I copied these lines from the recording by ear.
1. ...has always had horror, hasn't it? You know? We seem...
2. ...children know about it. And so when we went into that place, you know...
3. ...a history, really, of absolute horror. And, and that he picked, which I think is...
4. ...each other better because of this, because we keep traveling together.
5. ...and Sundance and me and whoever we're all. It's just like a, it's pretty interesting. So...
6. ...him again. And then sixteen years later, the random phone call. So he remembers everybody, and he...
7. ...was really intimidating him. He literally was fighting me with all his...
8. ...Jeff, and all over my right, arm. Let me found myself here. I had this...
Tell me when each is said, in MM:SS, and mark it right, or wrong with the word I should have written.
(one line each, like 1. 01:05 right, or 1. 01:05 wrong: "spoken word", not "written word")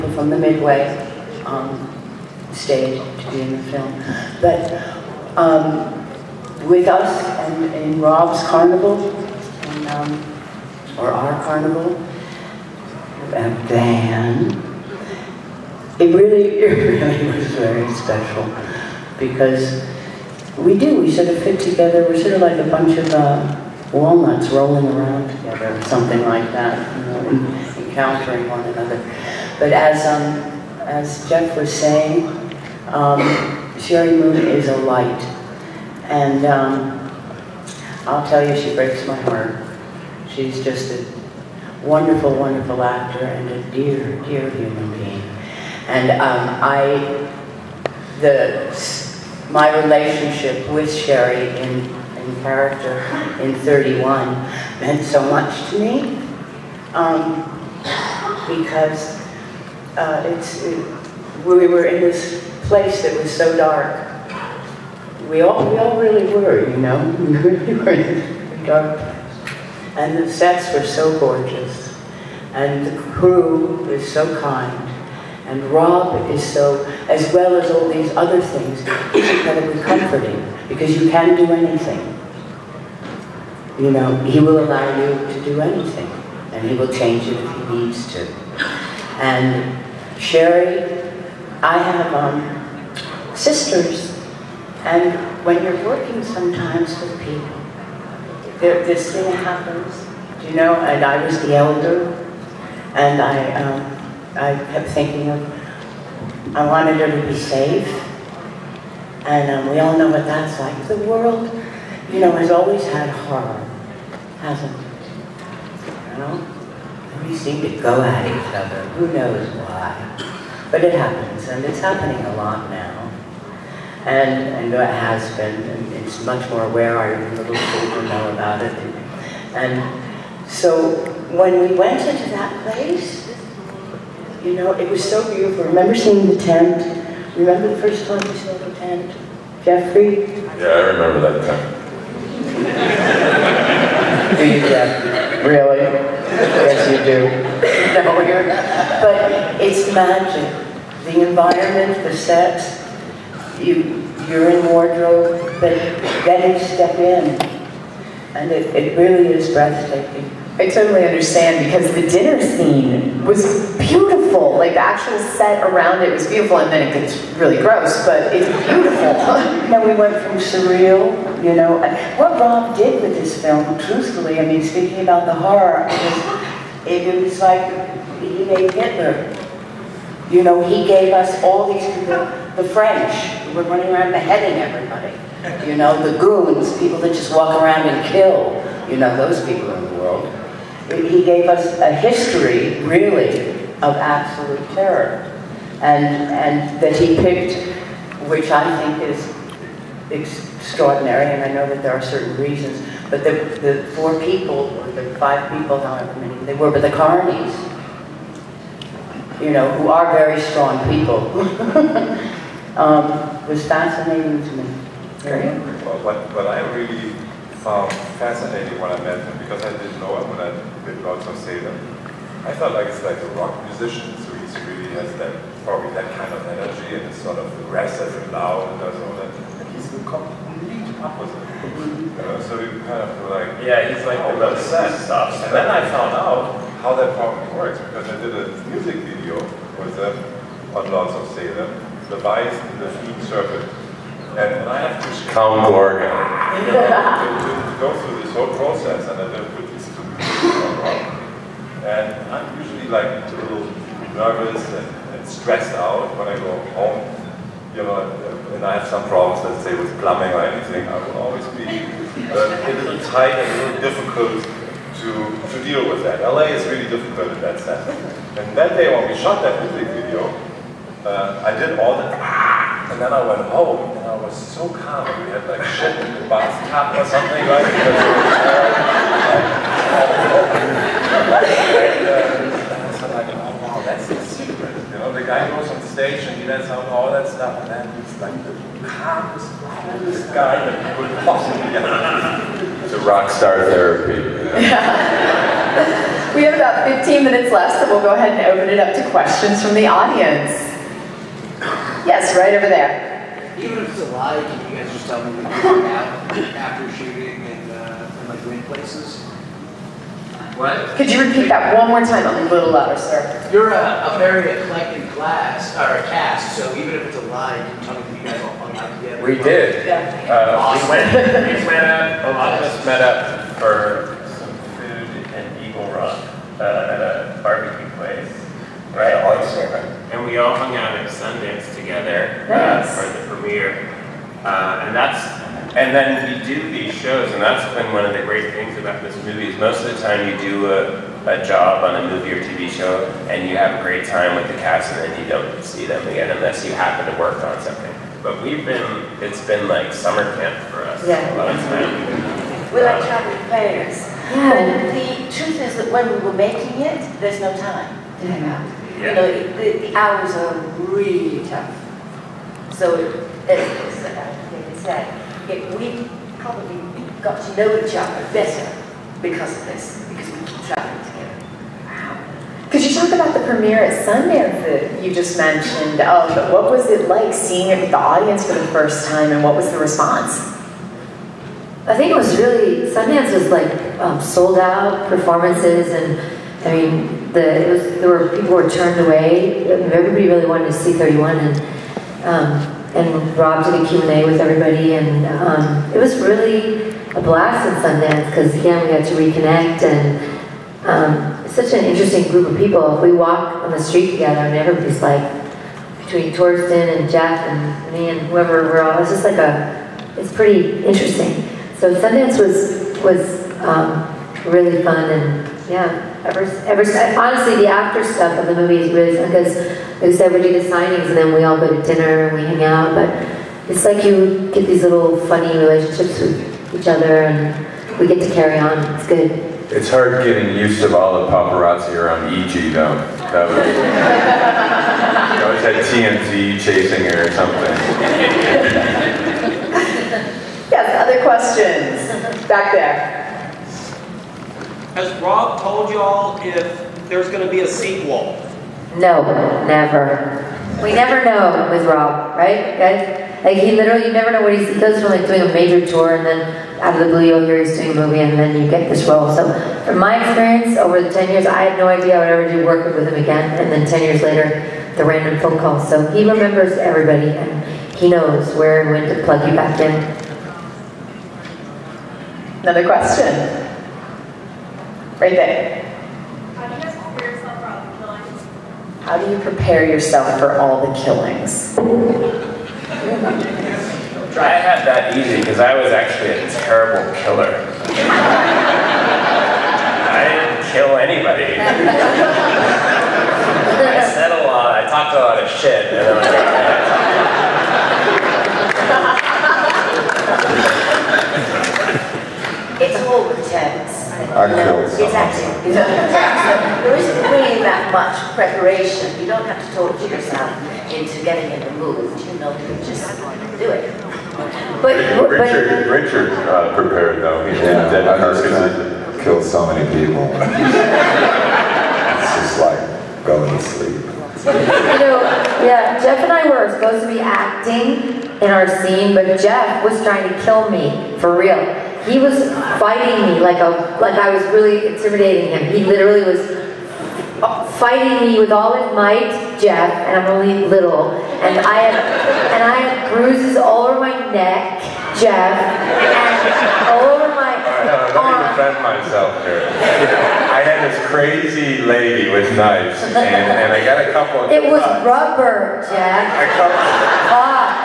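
1. 01:52 right
2. 02:07 right
3. 03:11 wrong: "terror", not "horror"
4. 06:07 right
5. 06:46 wrong: "Jeff", not "Sundance"
6. 07:43 wrong: "ten", not "sixteen"
7. 08:54 right
8. 09:05 wrong: "defend", not "found".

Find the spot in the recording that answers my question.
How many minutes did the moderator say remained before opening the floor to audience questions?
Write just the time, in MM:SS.
04:56.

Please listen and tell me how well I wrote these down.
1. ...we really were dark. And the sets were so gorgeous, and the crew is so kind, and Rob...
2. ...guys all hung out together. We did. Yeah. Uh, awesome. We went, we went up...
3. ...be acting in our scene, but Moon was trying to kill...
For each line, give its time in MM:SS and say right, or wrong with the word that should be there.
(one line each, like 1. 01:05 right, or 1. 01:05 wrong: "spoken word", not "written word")
1. 01:07 right
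2. 05:18 right
3. 08:47 wrong: "Jeff", not "Moon".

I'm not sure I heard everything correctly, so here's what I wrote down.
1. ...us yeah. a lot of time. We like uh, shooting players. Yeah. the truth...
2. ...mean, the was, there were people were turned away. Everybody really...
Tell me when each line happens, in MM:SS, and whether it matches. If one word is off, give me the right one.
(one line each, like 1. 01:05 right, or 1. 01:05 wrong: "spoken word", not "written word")
1. 05:50 wrong: "traveling", not "shooting"
2. 06:26 right.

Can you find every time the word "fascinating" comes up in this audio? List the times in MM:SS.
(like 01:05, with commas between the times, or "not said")
03:33, 03:38.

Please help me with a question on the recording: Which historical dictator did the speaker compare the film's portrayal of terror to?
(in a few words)
Hitler.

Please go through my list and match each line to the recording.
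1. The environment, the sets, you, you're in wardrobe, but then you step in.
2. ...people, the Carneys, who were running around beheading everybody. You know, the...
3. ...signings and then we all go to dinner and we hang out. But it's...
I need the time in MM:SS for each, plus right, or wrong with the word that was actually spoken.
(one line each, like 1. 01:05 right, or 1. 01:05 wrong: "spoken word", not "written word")
1. 02:31 right
2. 03:01 wrong: "French", not "Carneys"
3. 07:00 right.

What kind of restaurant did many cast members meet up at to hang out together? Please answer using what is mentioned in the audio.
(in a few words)
a barbecue place.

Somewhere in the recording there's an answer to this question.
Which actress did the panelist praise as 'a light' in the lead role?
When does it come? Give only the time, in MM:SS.
00:33.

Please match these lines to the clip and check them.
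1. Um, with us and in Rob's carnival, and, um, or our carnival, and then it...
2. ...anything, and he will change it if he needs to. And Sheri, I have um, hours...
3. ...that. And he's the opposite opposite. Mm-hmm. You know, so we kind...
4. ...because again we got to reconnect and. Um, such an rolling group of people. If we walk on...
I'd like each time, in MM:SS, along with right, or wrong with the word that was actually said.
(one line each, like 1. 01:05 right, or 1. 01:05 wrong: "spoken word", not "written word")
1. 00:05 right
2. 01:25 wrong: "sisters", not "hours"
3. 03:49 wrong: "complete", not "opposite"
4. 06:38 wrong: "interesting", not "rolling".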